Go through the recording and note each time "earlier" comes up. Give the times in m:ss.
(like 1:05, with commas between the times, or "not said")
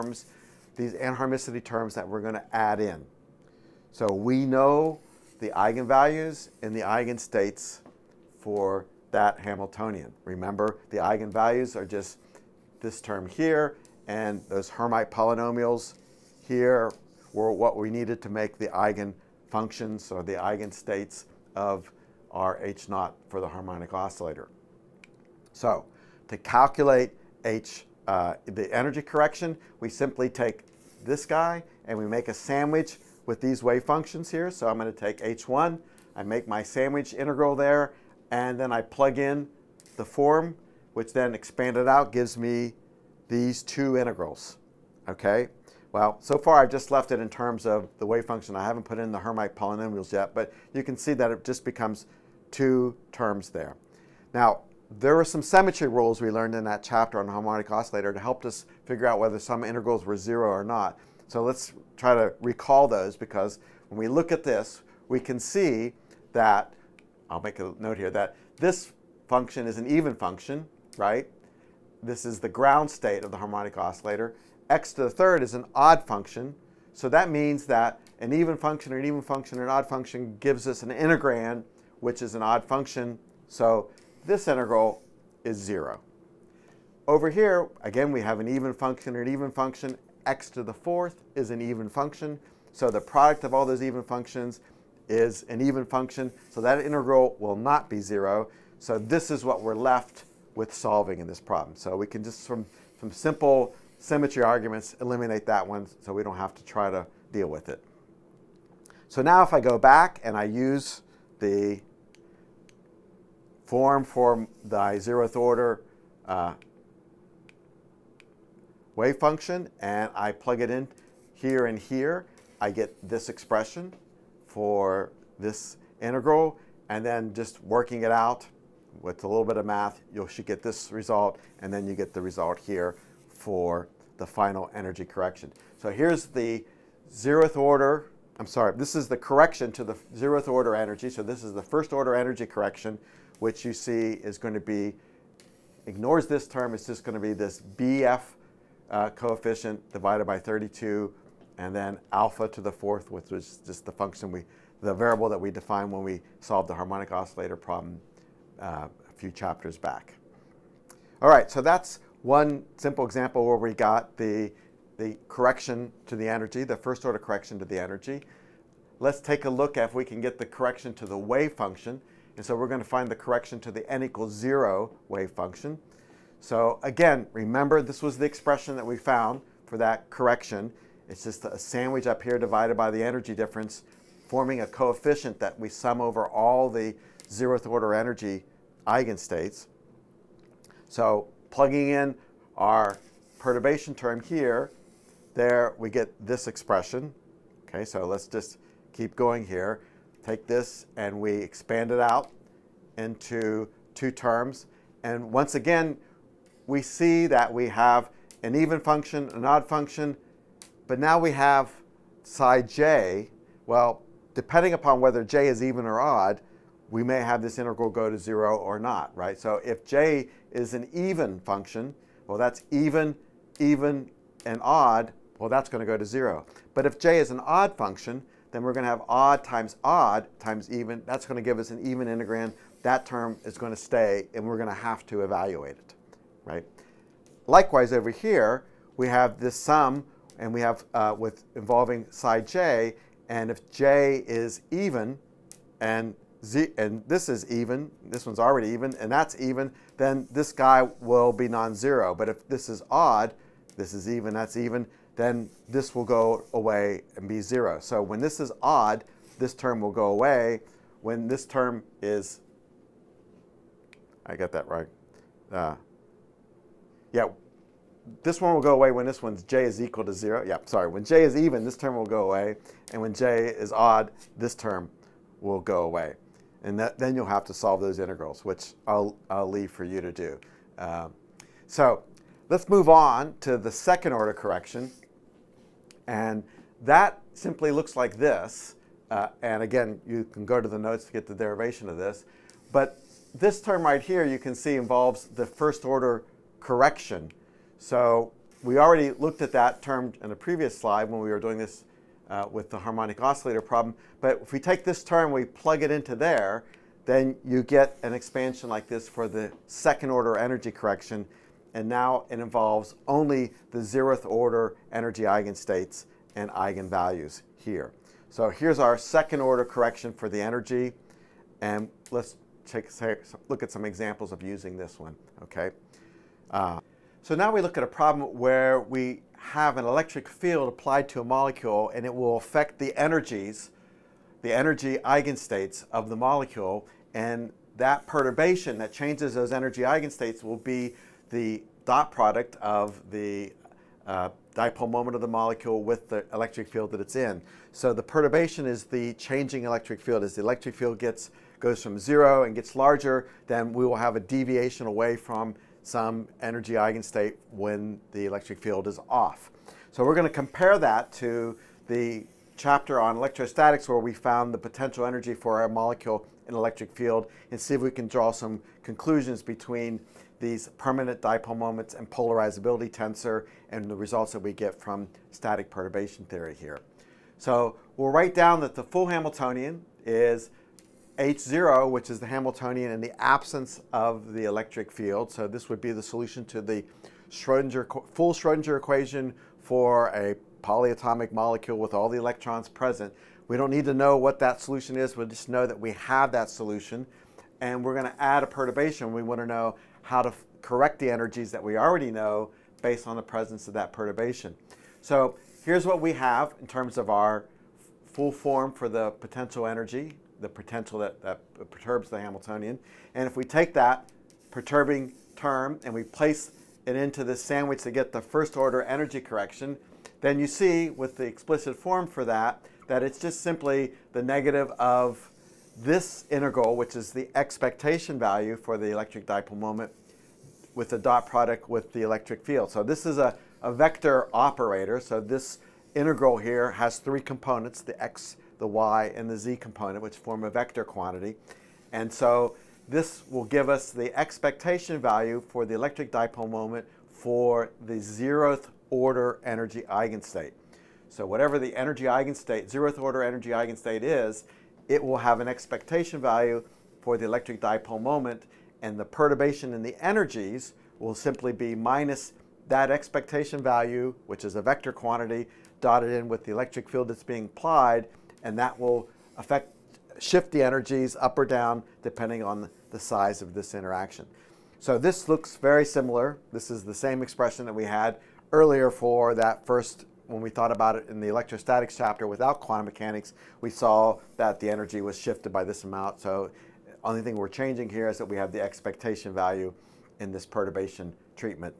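7:58.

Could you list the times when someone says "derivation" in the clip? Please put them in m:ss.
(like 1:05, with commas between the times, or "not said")
4:51.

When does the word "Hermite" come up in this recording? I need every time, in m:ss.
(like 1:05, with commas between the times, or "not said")
0:14, 0:49.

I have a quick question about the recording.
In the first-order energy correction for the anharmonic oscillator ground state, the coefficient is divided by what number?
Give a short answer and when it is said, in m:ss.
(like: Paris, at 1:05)
32, at 2:30.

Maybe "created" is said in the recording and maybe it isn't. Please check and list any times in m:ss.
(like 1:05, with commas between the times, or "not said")
not said.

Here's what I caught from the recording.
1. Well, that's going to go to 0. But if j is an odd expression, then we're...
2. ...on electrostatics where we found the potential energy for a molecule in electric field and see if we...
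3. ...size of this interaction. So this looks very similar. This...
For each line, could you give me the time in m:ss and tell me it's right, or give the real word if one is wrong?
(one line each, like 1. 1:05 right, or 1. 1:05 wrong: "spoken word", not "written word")
1. 3:45 wrong: "function", not "expression"
2. 6:02 right
3. 7:52 right.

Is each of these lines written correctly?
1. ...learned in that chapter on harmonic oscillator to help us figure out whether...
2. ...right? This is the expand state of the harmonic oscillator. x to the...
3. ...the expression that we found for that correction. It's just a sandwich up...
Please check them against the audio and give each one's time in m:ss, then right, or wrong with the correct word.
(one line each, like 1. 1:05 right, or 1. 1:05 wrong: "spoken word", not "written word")
1. 0:56 right
2. 1:10 wrong: "ground", not "expand"
3. 2:58 right.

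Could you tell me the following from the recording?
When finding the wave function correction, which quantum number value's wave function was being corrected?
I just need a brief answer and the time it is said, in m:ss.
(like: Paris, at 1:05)
n equals 0, at 2:53.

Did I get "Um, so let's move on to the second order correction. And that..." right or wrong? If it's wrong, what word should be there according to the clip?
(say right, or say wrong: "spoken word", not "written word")
right.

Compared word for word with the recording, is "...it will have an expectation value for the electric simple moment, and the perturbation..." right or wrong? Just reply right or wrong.
wrong.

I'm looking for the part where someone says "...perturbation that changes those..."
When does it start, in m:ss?
5:38.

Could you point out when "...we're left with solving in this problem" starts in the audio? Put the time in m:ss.
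1:39.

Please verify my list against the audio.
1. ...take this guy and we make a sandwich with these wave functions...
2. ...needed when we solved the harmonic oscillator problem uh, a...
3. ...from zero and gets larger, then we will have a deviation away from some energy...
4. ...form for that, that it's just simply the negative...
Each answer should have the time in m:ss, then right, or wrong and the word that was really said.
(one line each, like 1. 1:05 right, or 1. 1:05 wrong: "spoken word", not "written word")
1. 0:30 right
2. 2:35 wrong: "defined", not "needed"
3. 5:51 right
4. 7:01 right.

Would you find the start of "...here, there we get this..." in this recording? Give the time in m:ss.
3:14.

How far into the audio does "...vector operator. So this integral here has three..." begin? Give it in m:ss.
7:13.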